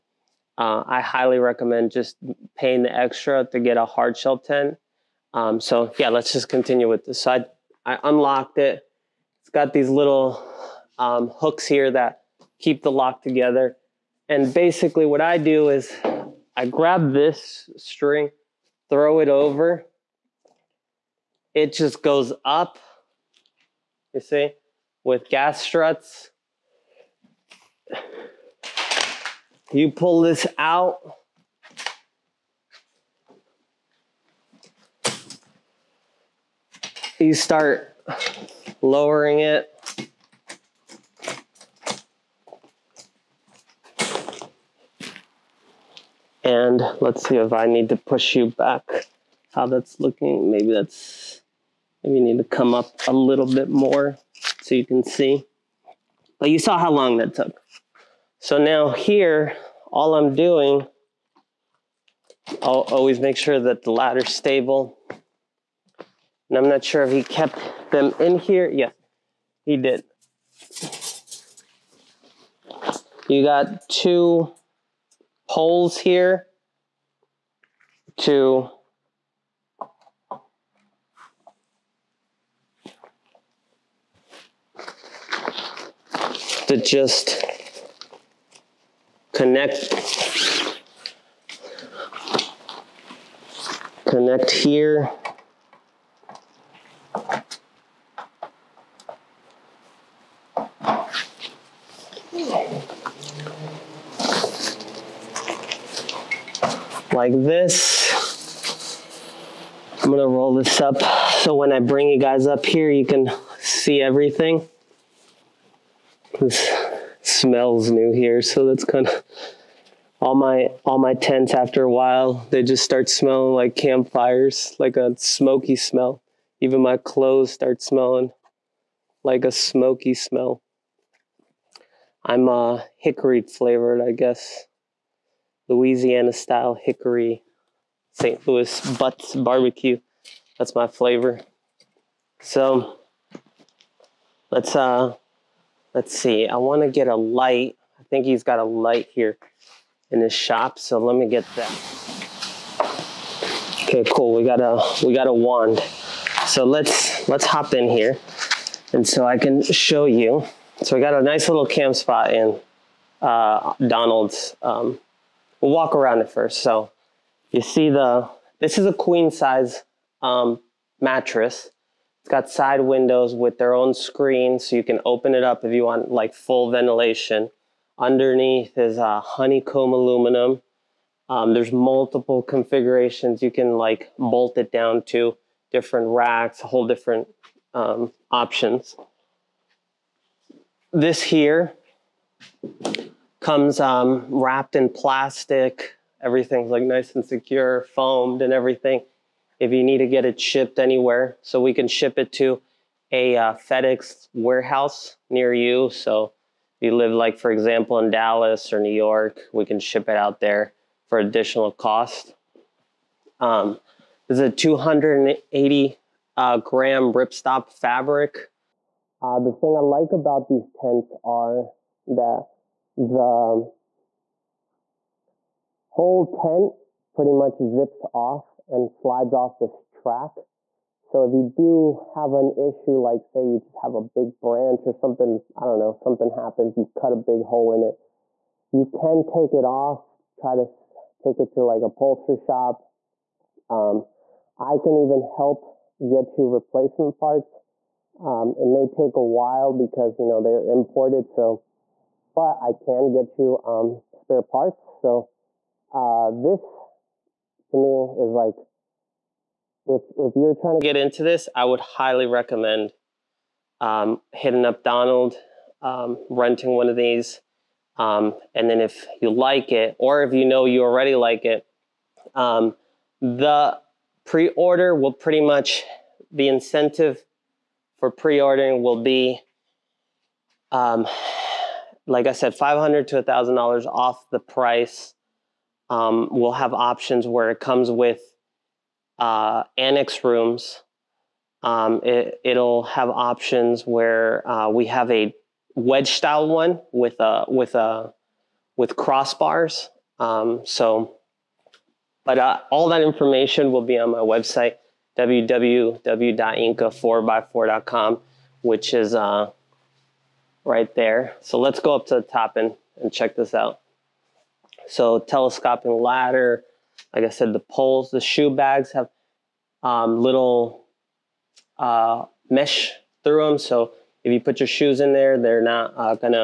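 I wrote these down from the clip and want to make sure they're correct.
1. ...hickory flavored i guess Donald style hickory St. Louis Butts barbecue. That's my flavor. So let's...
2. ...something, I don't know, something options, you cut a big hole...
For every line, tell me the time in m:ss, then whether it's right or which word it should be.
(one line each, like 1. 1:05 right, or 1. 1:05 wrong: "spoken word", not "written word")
1. 2:12 wrong: "Louisiana", not "Donald"
2. 3:54 wrong: "happens", not "options".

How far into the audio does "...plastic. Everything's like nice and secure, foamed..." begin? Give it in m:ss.
3:14.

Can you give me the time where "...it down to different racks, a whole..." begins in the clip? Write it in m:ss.
3:04.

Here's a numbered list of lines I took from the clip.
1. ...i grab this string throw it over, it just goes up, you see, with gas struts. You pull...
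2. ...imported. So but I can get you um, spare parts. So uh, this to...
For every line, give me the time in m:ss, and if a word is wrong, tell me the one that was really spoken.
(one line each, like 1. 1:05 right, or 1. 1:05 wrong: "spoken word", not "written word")
1. 0:16 right
2. 4:10 right.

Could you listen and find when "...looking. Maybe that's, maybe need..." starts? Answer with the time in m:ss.
0:49.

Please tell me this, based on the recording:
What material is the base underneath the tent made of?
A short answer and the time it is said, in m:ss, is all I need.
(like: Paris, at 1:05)
Honeycomb aluminum, at 2:59.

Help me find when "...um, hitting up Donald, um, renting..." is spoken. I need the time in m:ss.
4:23.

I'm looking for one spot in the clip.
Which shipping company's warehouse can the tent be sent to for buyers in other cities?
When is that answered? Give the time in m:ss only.
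3:23.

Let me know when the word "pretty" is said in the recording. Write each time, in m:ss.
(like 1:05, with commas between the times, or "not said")
3:47, 4:35.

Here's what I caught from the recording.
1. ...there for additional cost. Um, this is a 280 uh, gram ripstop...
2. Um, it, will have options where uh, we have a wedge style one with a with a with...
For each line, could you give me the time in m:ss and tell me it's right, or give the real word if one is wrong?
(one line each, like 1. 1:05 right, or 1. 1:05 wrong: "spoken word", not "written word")
1. 3:30 right
2. 4:51 right.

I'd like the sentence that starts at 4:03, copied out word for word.
Um, I can even help get you replacement parts.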